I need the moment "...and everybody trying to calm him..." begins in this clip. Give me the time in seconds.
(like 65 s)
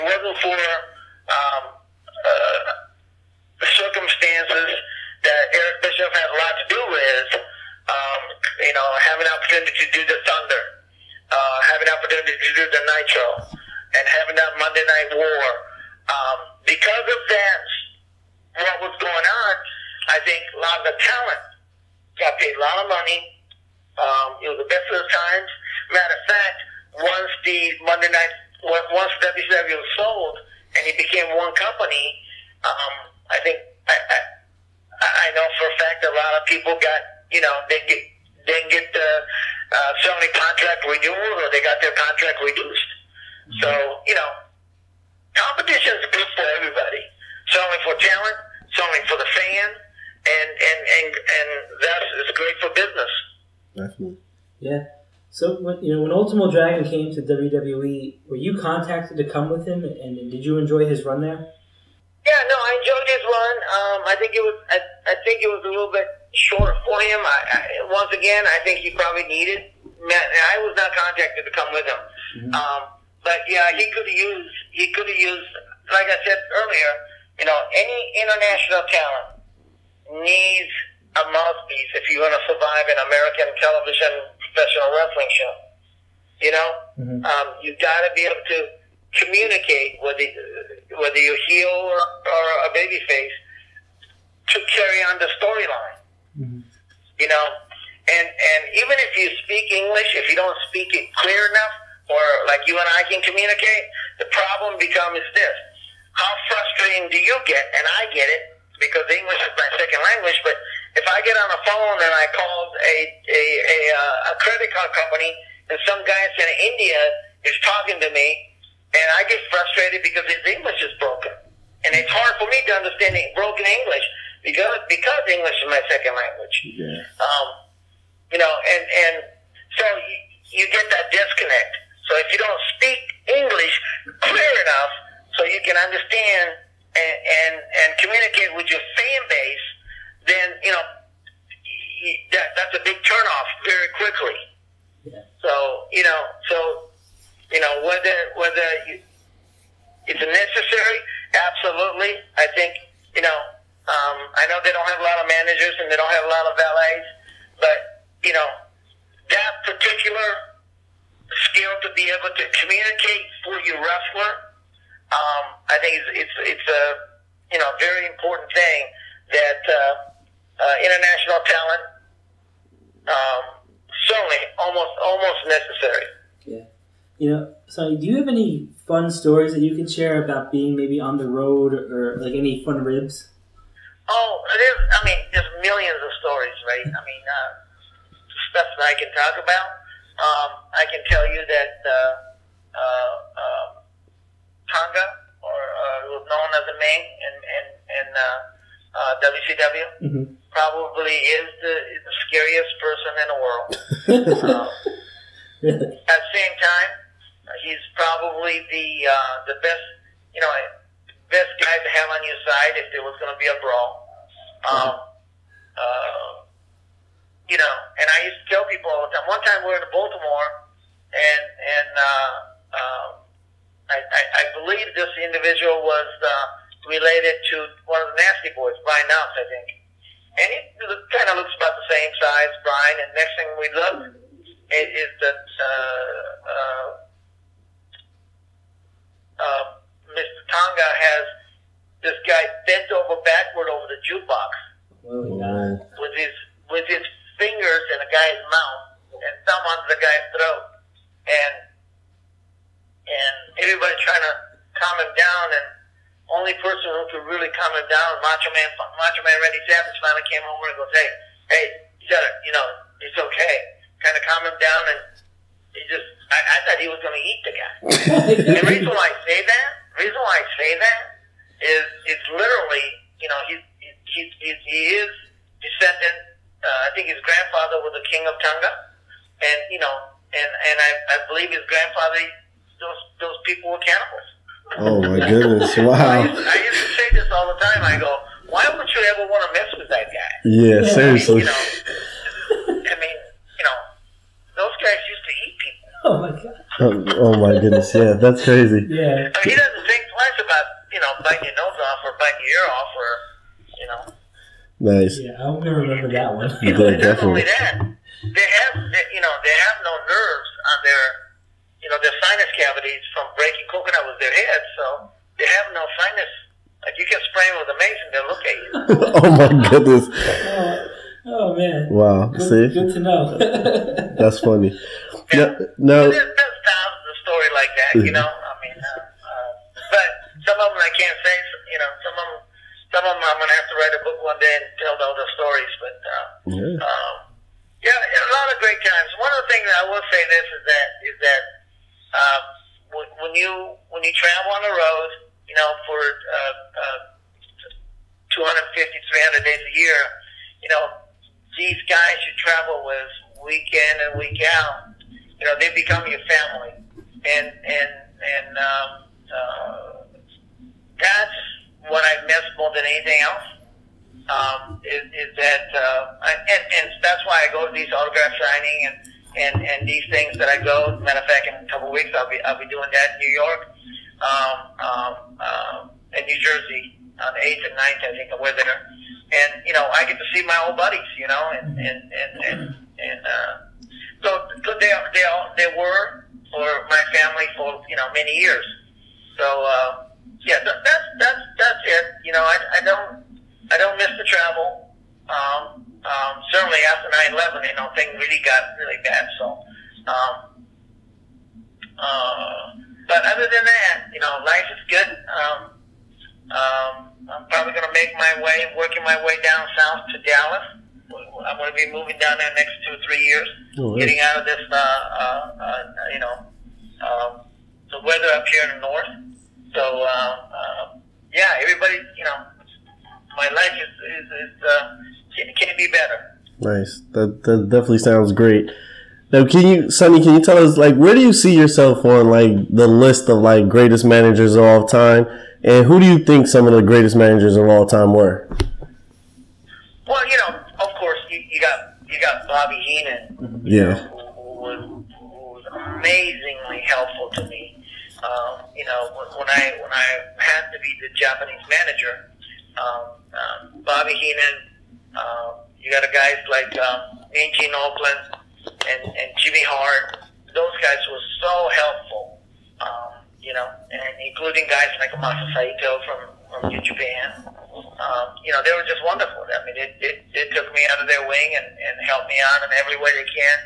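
253 s.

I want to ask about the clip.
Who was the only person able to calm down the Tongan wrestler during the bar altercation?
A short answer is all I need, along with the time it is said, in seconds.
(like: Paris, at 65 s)
Randy Savage, at 258 s.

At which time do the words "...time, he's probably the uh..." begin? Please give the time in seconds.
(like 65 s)
206 s.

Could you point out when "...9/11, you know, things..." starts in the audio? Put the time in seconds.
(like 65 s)
397 s.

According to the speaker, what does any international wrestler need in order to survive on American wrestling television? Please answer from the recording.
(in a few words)
A mouthpiece.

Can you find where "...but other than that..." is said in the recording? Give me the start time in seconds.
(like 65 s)
403 s.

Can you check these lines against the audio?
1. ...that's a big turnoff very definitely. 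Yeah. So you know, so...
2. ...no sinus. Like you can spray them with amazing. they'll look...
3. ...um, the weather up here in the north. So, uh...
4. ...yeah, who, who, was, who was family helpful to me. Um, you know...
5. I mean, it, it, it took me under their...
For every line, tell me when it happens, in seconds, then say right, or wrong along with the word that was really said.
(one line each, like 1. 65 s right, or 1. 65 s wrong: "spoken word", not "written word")
1. 142 s wrong: "quickly", not "definitely"
2. 315 s right
3. 417 s right
4. 443 s wrong: "amazingly", not "family"
5. 469 s right.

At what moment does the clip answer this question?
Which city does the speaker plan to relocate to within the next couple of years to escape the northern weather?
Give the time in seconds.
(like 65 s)
410 s.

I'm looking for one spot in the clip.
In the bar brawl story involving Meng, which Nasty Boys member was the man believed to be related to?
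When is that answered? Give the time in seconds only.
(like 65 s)
228 s.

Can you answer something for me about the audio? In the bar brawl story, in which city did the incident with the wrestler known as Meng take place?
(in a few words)
Baltimore.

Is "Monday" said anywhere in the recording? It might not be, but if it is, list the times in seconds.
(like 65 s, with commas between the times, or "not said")
14 s, 27 s.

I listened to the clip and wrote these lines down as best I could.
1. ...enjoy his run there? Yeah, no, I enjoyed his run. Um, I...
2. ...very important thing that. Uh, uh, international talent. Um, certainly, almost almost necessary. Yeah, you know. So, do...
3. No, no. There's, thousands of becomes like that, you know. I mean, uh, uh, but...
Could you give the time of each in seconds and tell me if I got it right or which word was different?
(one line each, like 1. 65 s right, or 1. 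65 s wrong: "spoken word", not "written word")
1. 60 s right
2. 167 s right
3. 325 s wrong: "stories", not "becomes".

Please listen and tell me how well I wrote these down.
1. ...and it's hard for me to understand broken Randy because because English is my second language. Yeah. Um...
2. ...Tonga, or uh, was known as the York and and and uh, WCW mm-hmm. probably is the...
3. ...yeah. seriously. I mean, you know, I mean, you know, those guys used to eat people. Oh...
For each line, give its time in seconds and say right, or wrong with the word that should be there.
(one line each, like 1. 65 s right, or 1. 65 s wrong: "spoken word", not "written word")
1. 121 s wrong: "English", not "Randy"
2. 194 s wrong: "Meng", not "York"
3. 290 s right.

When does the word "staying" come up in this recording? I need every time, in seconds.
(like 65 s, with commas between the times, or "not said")
not said.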